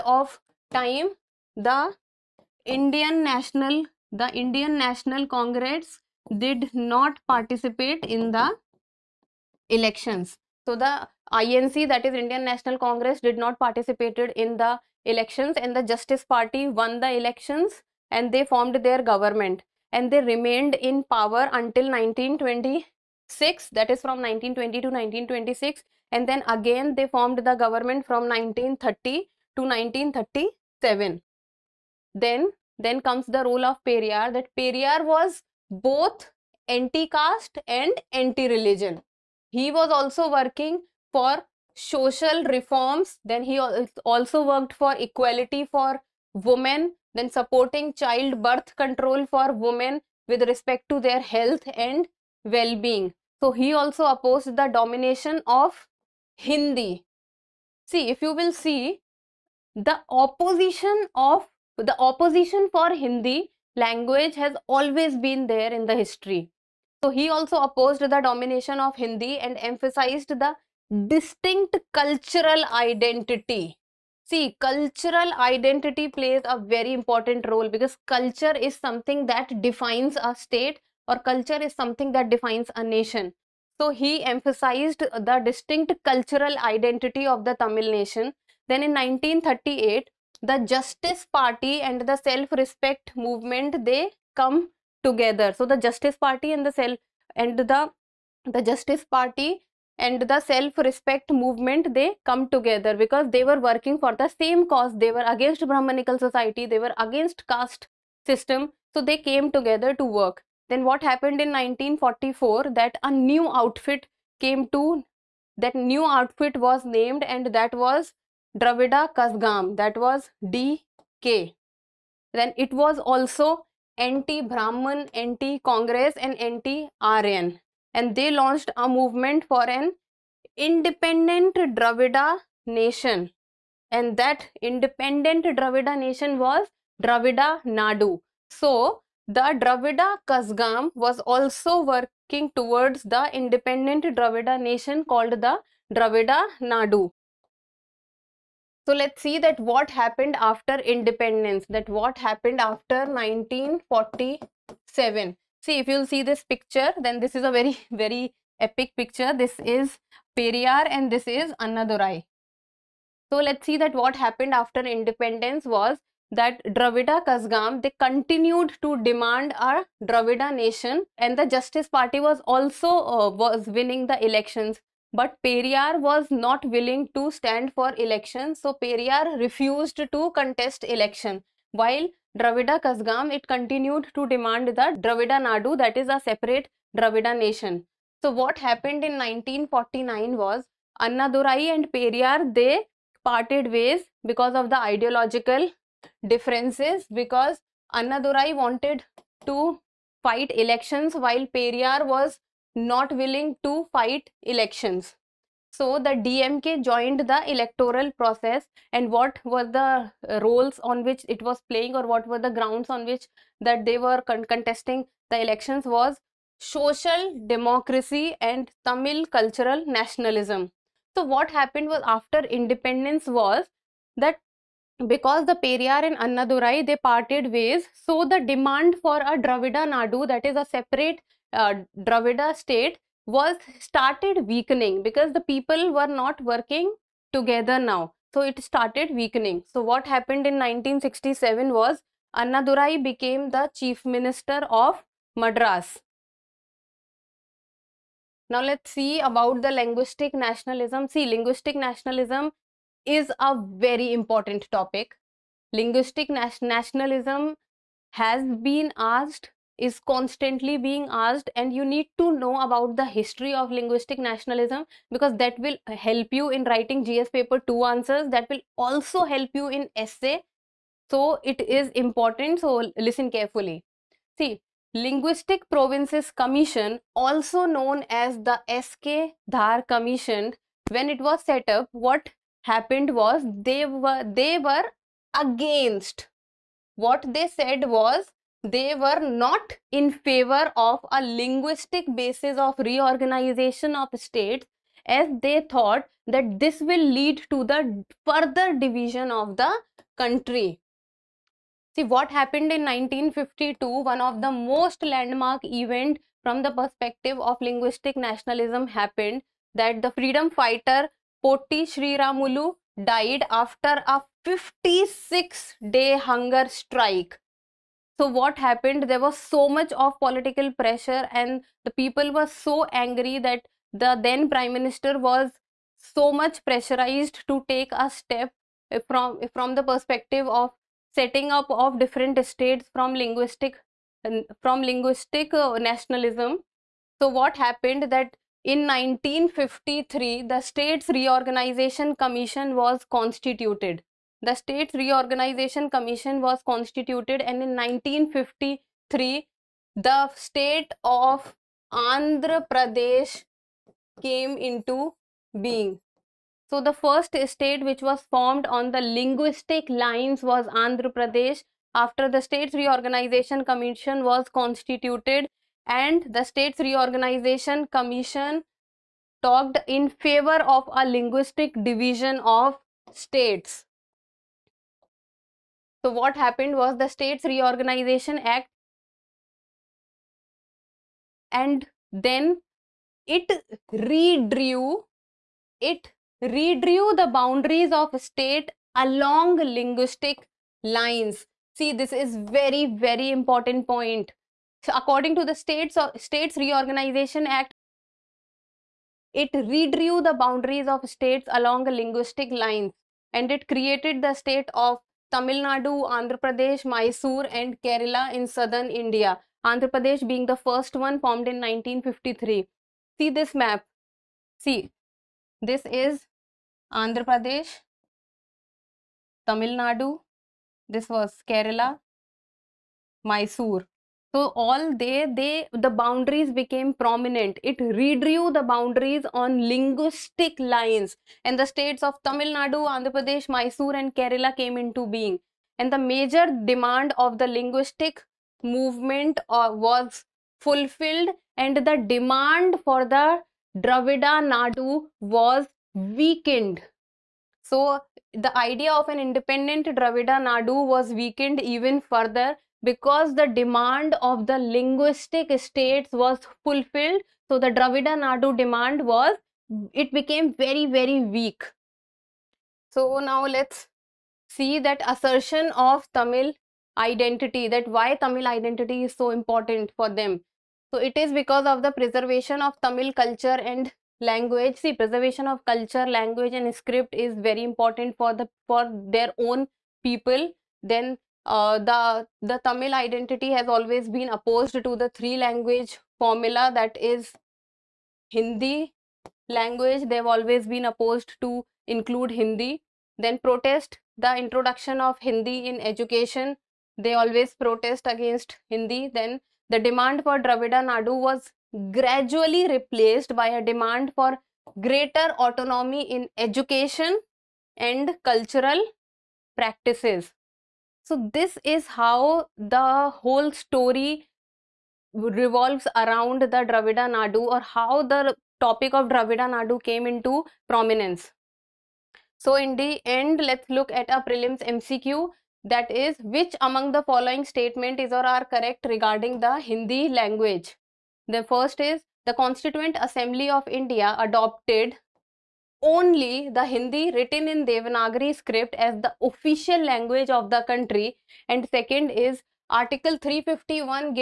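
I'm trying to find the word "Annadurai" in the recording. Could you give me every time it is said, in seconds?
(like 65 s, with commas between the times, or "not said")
161 s, 191 s, 197 s, 226 s, 242 s.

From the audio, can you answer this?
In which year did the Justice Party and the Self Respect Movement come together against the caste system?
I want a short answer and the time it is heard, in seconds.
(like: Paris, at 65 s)
1938, at 88 s.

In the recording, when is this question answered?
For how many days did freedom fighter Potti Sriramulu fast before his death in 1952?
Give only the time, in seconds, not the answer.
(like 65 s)
314 s.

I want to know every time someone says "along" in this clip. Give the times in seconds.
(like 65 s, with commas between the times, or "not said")
388 s, 401 s.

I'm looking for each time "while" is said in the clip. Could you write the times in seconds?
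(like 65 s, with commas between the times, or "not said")
181 s, 201 s.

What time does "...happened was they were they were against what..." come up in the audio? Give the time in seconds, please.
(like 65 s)
282 s.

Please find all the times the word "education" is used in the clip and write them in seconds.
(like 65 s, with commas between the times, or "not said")
495 s, 506 s.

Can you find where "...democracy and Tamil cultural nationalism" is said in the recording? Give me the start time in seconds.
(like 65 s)
217 s.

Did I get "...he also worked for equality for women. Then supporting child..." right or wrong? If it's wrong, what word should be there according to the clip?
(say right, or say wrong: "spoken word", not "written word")
right.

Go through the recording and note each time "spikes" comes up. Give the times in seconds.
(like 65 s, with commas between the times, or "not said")
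not said.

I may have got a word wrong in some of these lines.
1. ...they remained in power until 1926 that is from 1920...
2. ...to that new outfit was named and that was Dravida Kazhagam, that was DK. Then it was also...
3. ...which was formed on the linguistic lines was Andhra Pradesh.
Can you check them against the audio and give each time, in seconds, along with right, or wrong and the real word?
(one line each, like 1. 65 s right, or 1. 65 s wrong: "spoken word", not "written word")
1. 20 s right
2. 114 s right
3. 357 s right.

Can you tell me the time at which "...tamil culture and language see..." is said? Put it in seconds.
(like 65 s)
472 s.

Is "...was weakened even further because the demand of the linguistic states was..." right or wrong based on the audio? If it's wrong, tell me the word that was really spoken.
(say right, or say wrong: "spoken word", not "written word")
right.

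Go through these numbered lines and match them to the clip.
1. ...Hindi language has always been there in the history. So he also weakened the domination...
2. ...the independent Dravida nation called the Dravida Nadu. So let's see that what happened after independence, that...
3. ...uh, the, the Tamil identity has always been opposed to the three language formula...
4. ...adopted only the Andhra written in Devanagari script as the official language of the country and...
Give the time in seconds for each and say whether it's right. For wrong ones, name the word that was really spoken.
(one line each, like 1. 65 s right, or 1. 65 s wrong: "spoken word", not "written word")
1. 62 s wrong: "opposed", not "weakened"
2. 143 s right
3. 481 s right
4. 534 s wrong: "Hindi", not "Andhra".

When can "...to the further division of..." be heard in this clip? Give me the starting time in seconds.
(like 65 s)
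297 s.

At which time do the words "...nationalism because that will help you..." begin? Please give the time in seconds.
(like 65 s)
264 s.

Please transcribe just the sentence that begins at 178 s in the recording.
So Periyar refused to contest election.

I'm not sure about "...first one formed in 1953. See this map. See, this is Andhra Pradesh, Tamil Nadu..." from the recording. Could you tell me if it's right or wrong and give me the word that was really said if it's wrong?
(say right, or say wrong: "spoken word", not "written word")
right.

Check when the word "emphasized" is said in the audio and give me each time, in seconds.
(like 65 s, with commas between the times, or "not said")
69 s, 84 s.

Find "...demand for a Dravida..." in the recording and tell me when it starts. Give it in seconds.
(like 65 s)
228 s.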